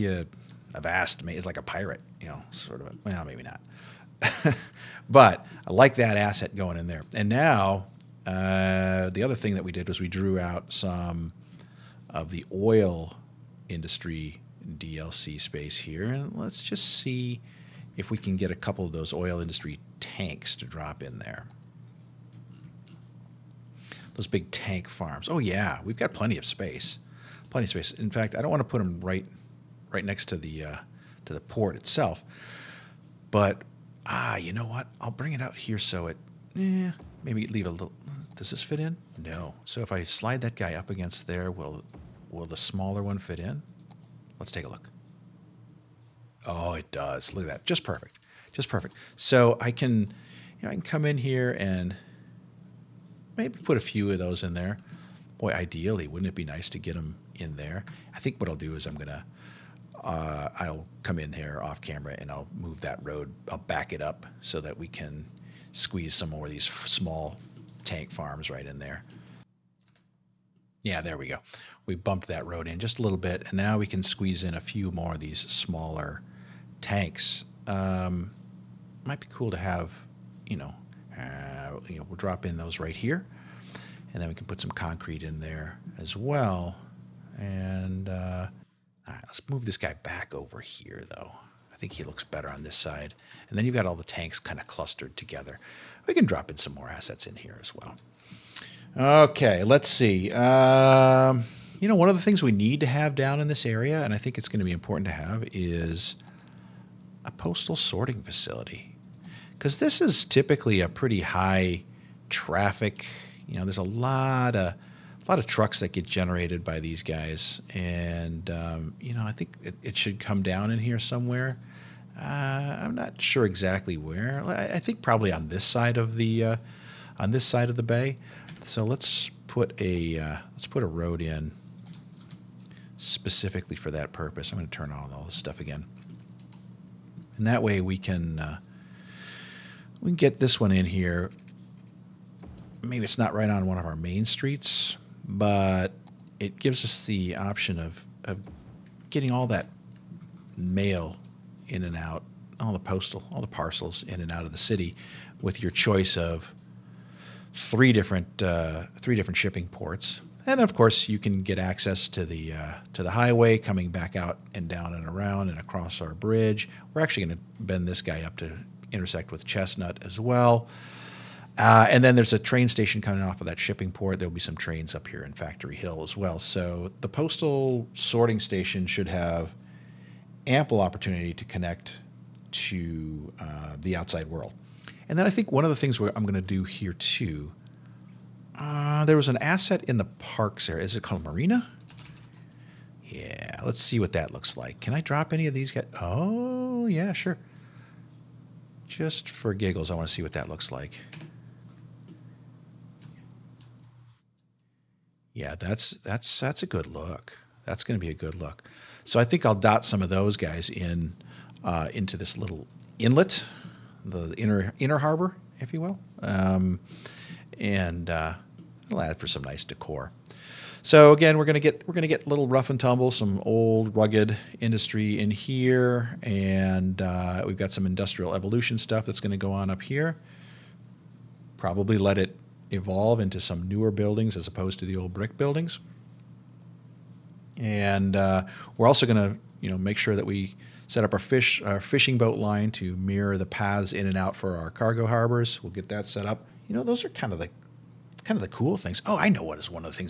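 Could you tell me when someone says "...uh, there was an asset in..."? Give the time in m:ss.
3:08.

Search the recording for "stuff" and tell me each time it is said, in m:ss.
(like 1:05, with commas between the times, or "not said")
2:15, 3:48.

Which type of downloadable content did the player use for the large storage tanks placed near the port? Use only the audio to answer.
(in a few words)
Oil industry DLC.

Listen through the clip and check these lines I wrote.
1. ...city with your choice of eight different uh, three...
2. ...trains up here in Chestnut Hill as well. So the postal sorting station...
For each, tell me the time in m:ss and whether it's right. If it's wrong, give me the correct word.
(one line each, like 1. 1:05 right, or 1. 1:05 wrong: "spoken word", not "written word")
1. 2:34 wrong: "three", not "eight"
2. 2:54 wrong: "Factory", not "Chestnut".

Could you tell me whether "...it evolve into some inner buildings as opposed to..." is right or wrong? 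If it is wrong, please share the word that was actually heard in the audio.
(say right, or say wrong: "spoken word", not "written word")
wrong: "newer", not "inner".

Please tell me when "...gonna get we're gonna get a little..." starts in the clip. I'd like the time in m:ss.
3:41.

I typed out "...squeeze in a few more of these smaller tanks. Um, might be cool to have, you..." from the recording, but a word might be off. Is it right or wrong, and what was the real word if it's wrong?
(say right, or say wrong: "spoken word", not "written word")
right.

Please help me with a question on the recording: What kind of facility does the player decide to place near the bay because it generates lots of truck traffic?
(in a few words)
Postal sorting facility.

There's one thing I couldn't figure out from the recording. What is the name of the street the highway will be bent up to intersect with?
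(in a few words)
Chestnut.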